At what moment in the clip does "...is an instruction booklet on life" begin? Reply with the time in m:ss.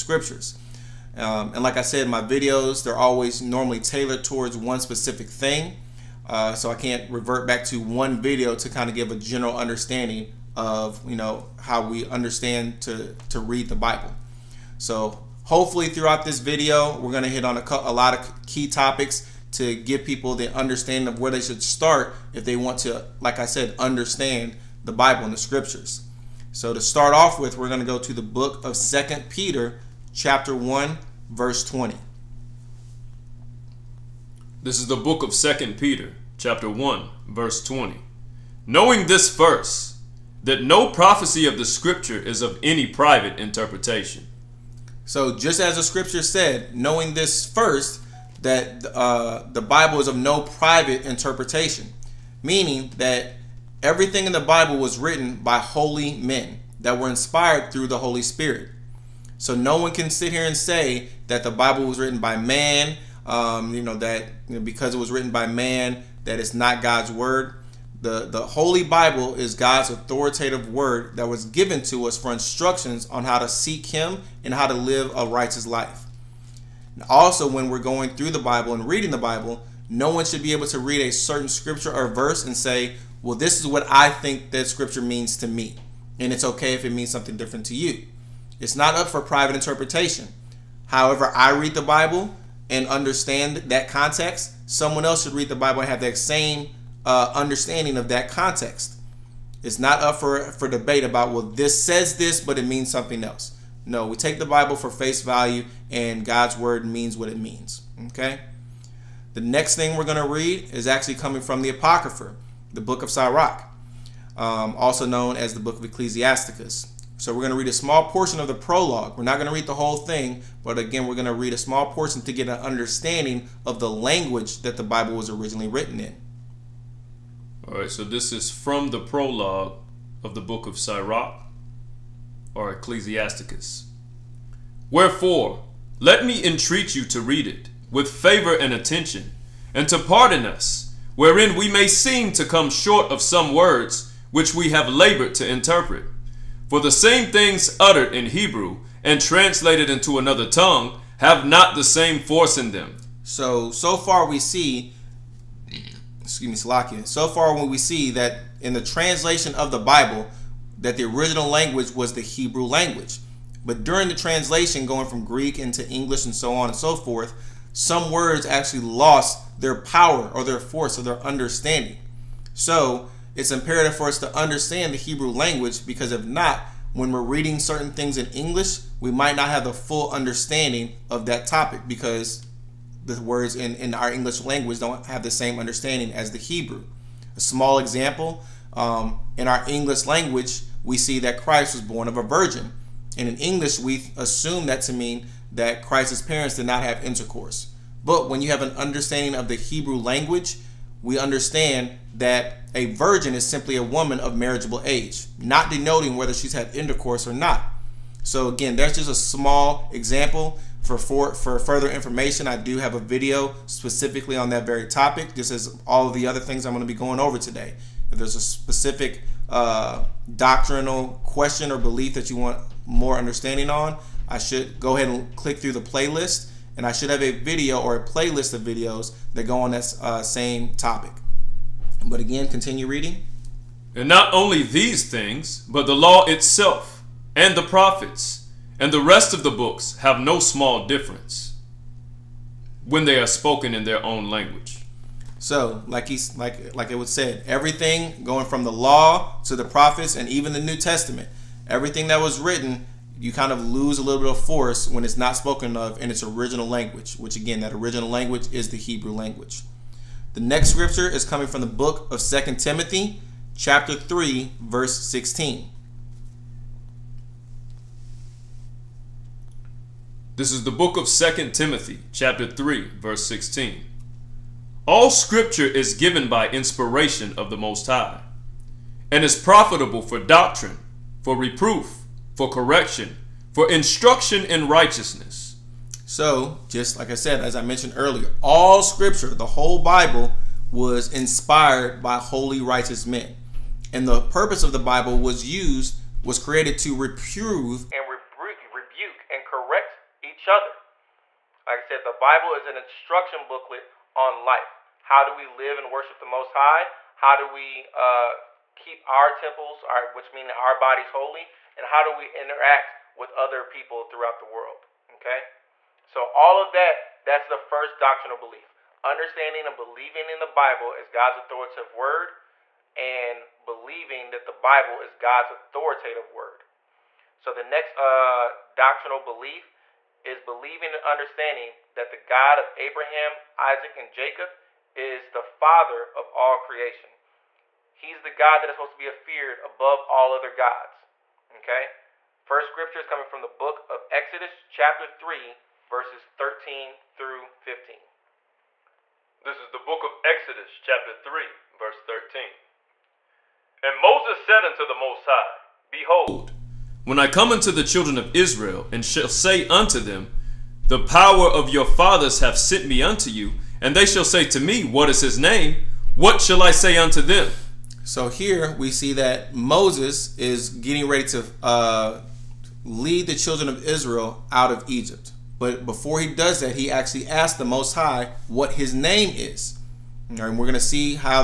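5:02.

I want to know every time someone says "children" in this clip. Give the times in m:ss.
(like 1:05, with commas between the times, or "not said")
5:57, 6:13.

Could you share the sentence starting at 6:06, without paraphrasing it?
What shall I say unto them?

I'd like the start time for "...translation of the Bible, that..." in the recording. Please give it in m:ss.
2:38.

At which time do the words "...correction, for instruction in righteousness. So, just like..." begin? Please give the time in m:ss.
4:42.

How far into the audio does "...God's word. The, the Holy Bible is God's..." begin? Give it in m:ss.
1:06.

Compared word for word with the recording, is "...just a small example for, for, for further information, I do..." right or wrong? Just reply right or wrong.
right.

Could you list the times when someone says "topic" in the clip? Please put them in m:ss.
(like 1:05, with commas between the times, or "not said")
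0:18, 3:01, 3:34, 3:50.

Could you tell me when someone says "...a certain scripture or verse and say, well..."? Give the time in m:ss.
1:20.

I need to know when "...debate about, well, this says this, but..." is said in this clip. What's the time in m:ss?
1:40.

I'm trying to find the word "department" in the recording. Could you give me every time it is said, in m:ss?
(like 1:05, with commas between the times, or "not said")
not said.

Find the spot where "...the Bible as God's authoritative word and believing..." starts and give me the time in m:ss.
5:20.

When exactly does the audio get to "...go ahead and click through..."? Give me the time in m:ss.
3:44.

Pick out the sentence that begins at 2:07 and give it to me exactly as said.
All right, so this is from the prologue of the book of Sirach or Ecclesiasticus.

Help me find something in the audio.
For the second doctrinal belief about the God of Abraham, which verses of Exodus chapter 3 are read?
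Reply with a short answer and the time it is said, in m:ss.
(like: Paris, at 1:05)
13 through 15, at 5:45.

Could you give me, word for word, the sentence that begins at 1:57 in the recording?
So we're going to read a small portion of the prologue.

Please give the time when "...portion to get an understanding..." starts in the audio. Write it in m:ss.
2:01.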